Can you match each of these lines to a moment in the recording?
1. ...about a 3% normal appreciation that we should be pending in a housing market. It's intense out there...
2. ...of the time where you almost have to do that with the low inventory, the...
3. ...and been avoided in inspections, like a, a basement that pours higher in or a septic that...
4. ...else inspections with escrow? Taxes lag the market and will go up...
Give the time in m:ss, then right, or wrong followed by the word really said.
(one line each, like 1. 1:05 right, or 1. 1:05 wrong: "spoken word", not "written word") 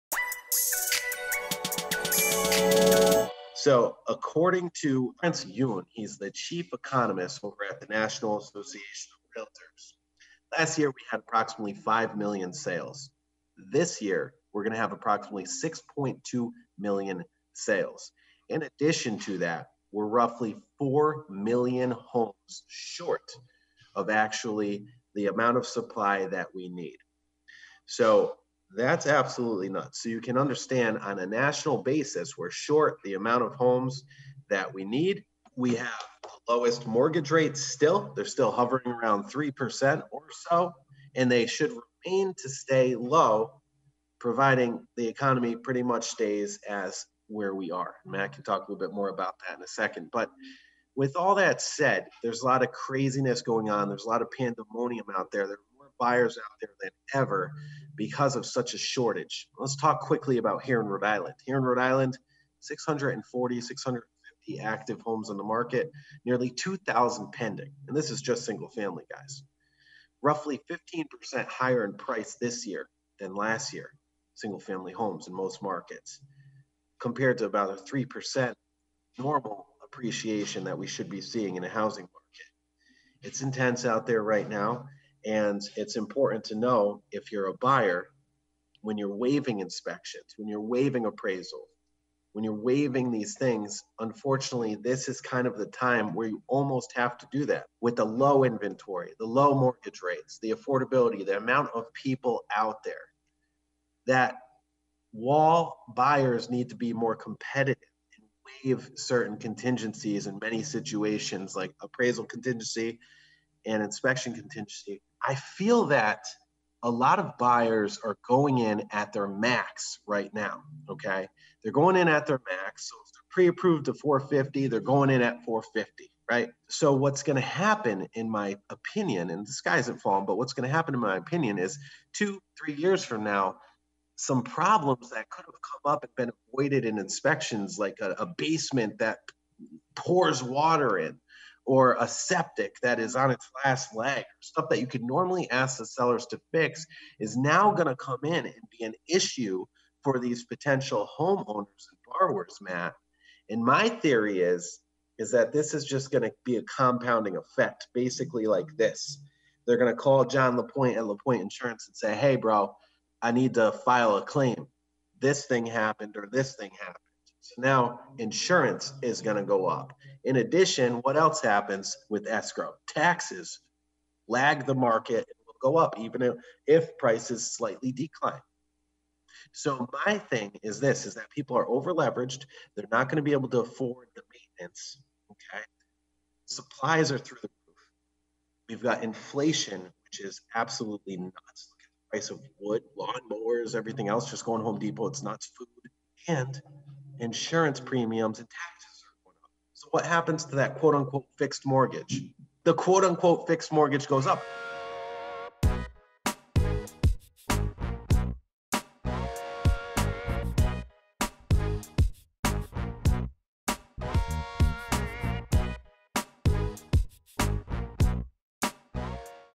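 1. 1:17 wrong: "seeing", not "pending"
2. 1:35 right
3. 2:16 wrong: "water", not "higher"
4. 2:51 wrong: "happens", not "inspections".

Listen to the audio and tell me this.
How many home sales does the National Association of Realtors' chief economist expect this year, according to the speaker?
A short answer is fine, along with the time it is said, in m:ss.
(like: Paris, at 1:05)
6.2 million, at 0:15.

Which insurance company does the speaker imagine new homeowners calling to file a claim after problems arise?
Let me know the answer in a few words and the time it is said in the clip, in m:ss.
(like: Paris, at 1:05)
Lapointe Insurance, at 2:41.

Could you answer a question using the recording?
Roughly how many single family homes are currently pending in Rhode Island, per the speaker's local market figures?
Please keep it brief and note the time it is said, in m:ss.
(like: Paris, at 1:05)
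2,000, at 1:06.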